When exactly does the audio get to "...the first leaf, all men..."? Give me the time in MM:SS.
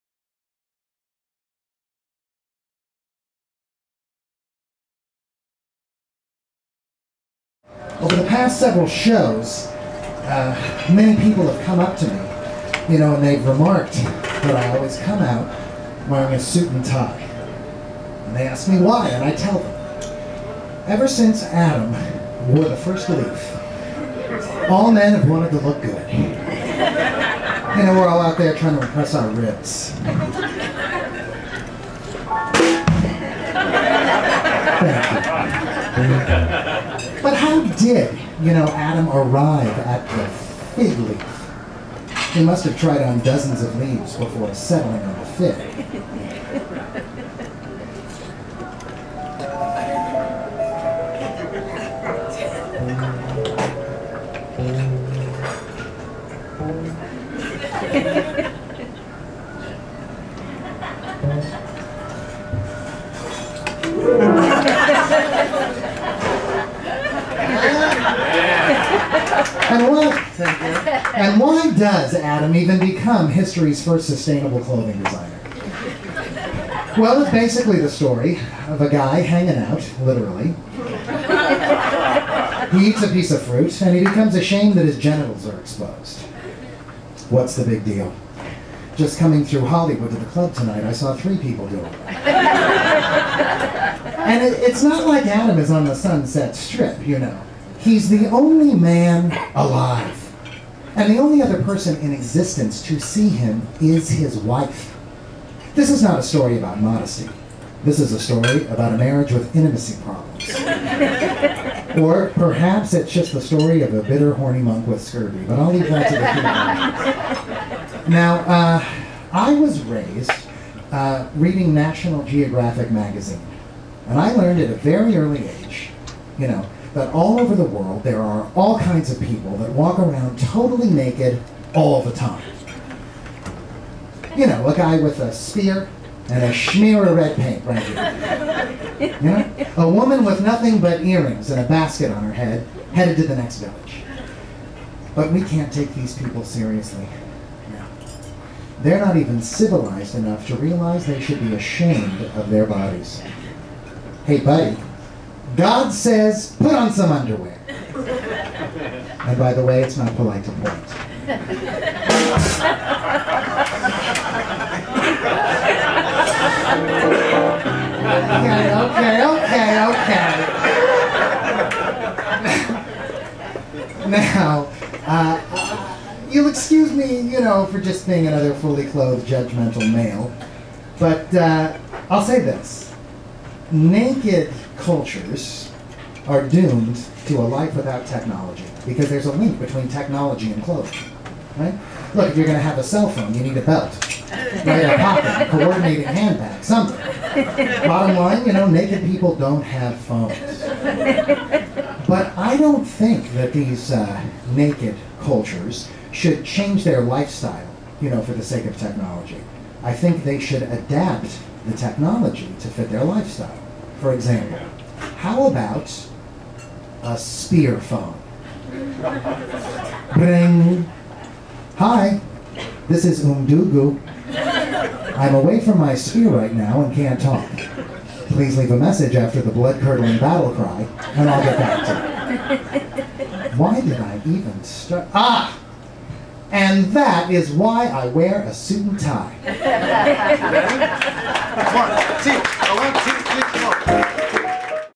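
00:22.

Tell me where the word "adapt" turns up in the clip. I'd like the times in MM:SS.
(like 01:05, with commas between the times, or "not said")
03:30.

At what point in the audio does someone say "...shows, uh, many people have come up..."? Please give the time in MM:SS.
00:08.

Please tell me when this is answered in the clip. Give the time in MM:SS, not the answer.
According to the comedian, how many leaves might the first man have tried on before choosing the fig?
00:43.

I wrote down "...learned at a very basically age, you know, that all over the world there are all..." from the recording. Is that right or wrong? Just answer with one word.
wrong.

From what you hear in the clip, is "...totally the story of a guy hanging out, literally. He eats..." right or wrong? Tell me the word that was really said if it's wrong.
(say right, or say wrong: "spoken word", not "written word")
wrong: "basically", not "totally".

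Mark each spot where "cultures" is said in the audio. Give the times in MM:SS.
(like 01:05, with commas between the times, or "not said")
03:04, 03:25.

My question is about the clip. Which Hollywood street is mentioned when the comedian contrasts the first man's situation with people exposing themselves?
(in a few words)
Sunset Strip.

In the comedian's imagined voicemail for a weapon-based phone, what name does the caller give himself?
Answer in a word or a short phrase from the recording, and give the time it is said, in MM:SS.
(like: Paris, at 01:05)
Umdugu, at 03:43.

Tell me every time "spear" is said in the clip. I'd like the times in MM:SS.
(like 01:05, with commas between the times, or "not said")
02:15, 03:37, 03:45.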